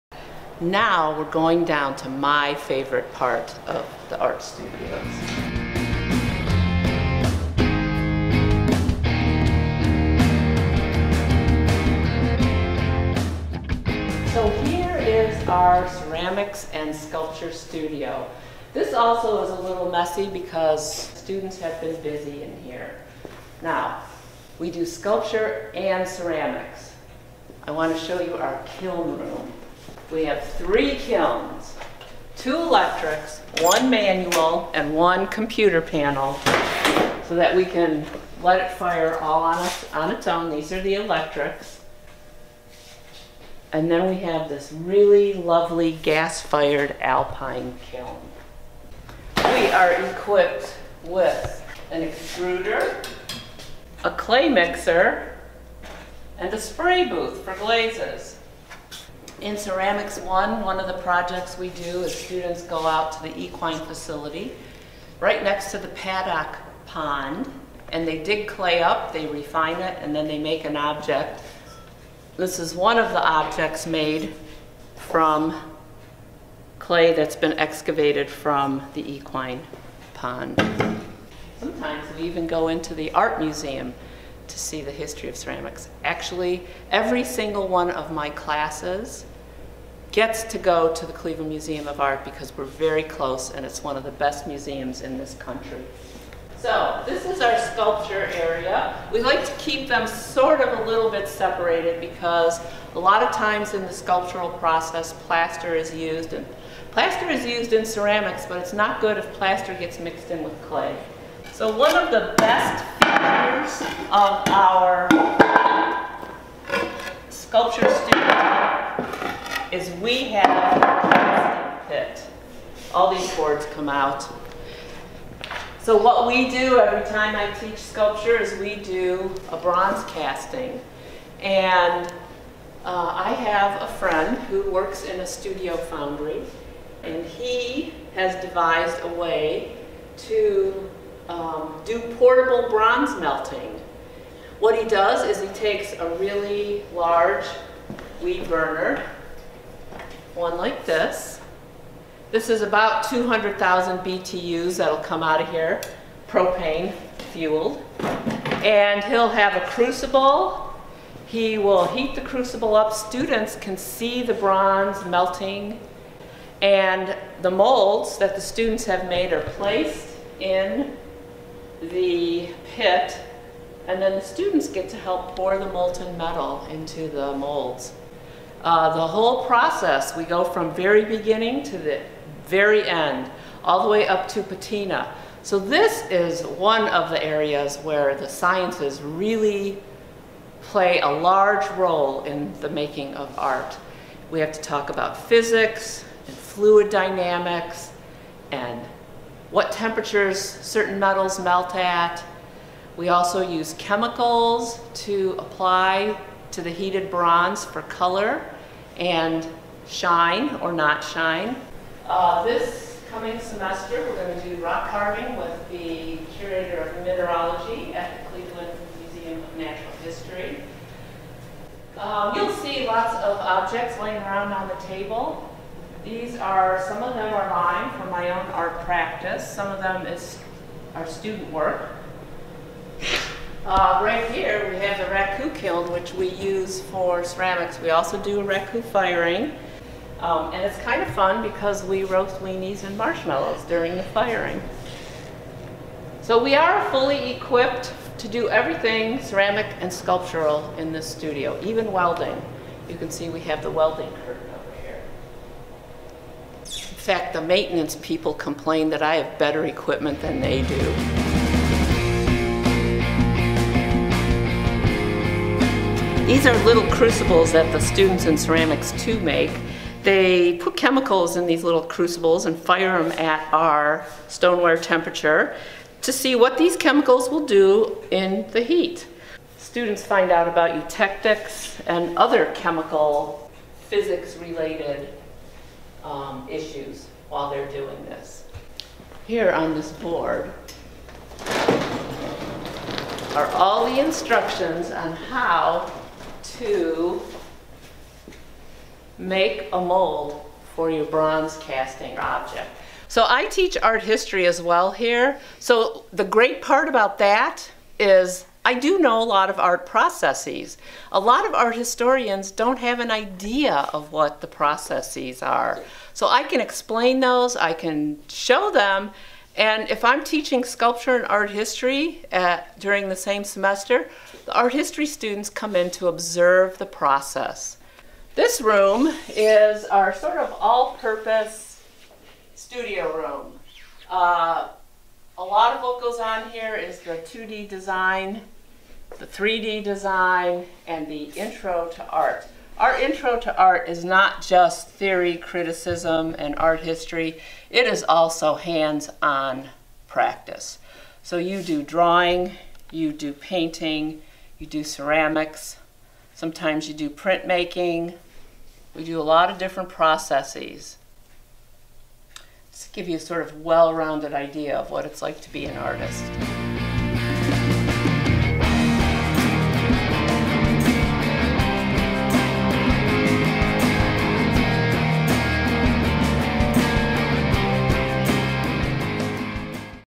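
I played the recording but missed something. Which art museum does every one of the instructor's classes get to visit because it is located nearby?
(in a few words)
Cleveland Museum of Art.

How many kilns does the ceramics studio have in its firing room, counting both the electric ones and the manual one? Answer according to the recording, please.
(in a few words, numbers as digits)
3.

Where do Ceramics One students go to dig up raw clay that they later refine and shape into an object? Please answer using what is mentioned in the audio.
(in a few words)
the equine facility.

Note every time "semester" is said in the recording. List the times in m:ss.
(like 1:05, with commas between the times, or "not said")
3:33, 5:23.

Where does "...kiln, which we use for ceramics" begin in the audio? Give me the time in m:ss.
3:55.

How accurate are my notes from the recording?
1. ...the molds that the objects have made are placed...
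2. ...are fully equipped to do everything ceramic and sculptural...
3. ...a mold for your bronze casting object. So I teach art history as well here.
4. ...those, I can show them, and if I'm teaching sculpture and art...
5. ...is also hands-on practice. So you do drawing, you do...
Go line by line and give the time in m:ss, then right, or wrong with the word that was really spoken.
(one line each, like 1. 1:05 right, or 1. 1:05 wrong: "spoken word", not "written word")
1. 2:47 wrong: "students", not "objects"
2. 4:06 right
3. 4:59 right
4. 5:17 right
5. 5:47 right.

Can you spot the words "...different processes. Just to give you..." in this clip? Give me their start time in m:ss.
5:59.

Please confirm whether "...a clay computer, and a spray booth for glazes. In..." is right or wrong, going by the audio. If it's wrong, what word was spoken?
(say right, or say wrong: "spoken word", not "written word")
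wrong: "mixer", not "computer".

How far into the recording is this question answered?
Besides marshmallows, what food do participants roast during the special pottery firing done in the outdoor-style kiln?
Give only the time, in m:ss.
4:02.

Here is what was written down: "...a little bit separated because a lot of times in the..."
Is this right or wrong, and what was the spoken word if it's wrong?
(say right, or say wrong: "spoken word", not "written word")
right.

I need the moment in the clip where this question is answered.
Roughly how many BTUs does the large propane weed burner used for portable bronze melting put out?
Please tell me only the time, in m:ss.
2:33.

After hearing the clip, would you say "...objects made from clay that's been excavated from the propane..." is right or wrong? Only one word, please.
wrong.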